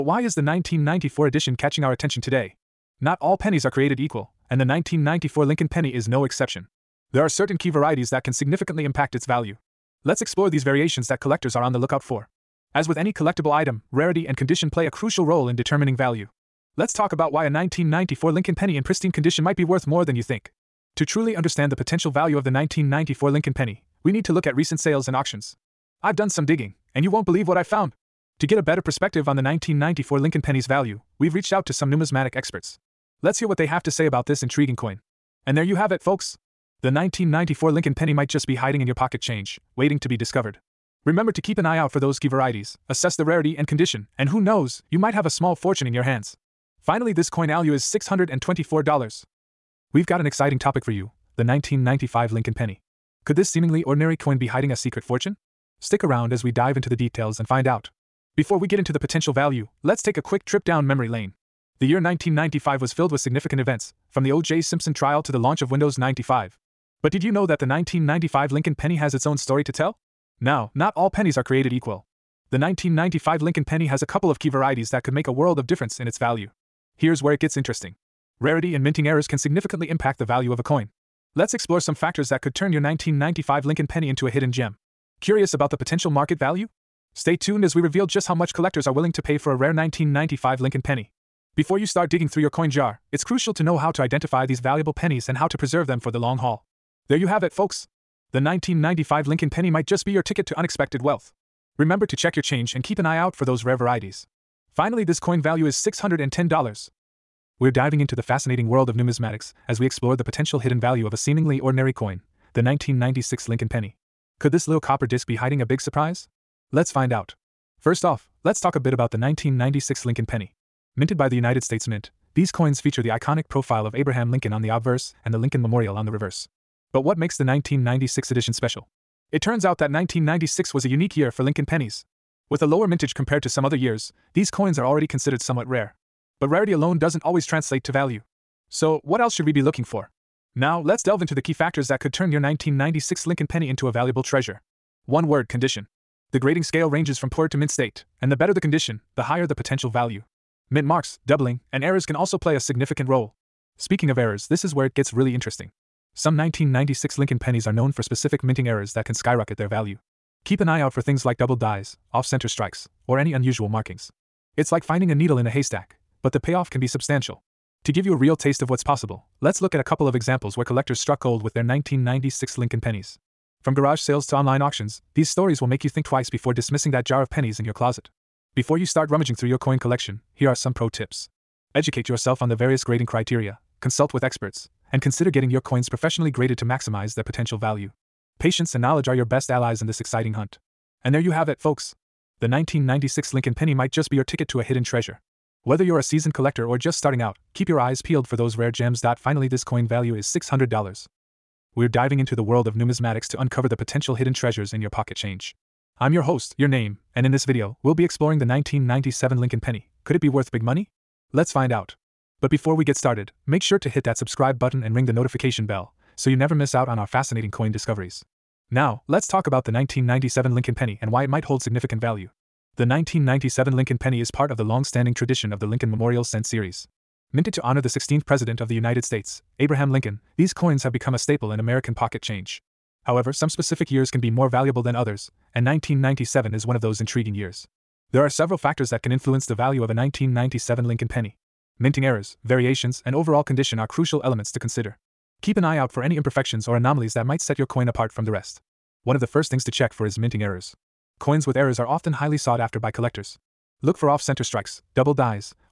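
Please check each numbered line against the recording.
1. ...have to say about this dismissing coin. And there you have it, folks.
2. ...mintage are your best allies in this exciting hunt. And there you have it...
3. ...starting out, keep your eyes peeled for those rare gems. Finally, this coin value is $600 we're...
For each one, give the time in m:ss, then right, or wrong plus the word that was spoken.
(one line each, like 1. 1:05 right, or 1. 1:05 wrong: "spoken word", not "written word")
1. 0:33 wrong: "intriguing", not "dismissing"
2. 3:08 wrong: "knowledge", not "mintage"
3. 3:16 right.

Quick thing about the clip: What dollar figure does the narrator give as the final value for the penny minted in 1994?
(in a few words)
$624.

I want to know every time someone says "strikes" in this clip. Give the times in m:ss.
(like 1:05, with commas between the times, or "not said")
2:42, 4:14.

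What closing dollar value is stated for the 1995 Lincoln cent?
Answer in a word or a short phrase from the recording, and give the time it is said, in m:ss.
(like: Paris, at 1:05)
$610, at 1:45.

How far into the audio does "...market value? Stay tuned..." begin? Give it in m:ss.
1:26.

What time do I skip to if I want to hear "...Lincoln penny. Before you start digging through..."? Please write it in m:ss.
1:30.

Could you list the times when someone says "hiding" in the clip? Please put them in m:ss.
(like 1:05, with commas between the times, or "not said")
0:38, 0:54, 1:55.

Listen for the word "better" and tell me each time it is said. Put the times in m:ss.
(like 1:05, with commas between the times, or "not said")
0:28, 2:28.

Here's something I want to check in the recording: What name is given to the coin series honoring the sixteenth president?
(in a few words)
Lincoln Memorial Cent.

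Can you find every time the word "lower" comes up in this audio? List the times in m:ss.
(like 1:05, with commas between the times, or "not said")
2:12.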